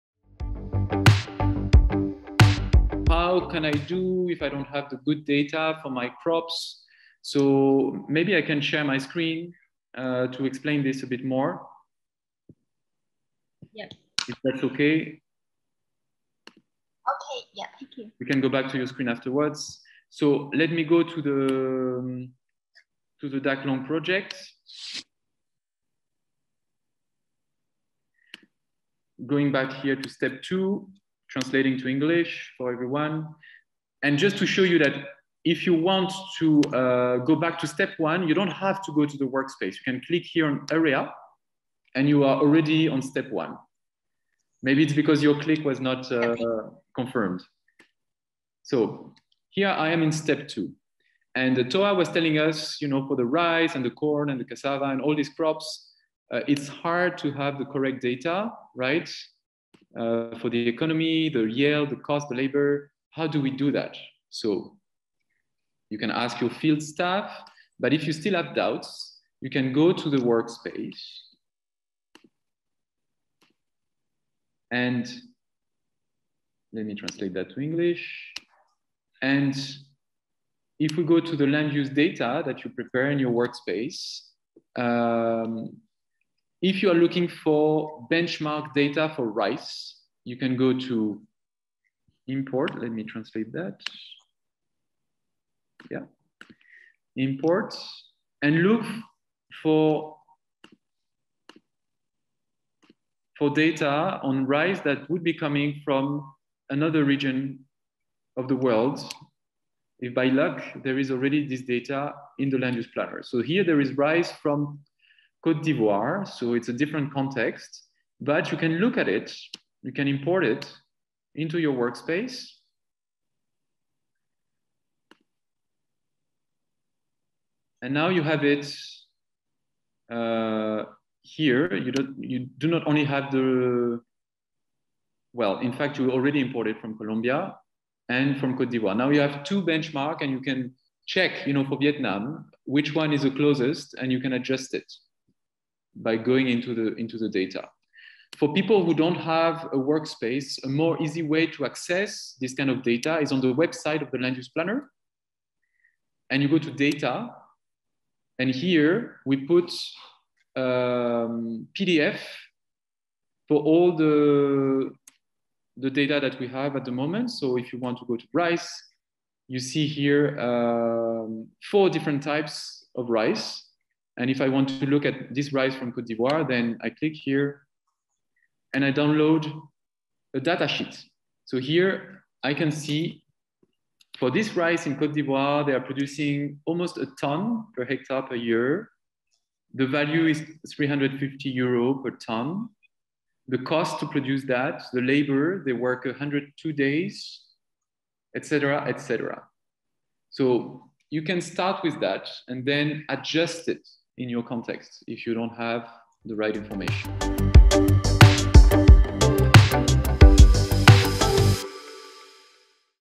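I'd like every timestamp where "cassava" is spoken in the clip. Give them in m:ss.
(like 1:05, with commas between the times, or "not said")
0:54.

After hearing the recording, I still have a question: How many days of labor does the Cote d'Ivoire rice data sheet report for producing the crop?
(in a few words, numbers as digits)
102 days.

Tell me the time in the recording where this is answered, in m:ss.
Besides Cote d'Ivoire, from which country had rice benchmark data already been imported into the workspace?
2:16.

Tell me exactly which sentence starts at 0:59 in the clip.
uh, for the economy, the yield, the cost, the labor.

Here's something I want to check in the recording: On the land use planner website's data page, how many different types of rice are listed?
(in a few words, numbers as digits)
4.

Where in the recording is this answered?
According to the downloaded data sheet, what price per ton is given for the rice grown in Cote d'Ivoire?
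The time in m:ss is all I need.
3:10.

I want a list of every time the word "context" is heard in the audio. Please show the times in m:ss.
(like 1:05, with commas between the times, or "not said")
1:57, 3:24.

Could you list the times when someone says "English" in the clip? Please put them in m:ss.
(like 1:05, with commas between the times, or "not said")
0:31, 1:17.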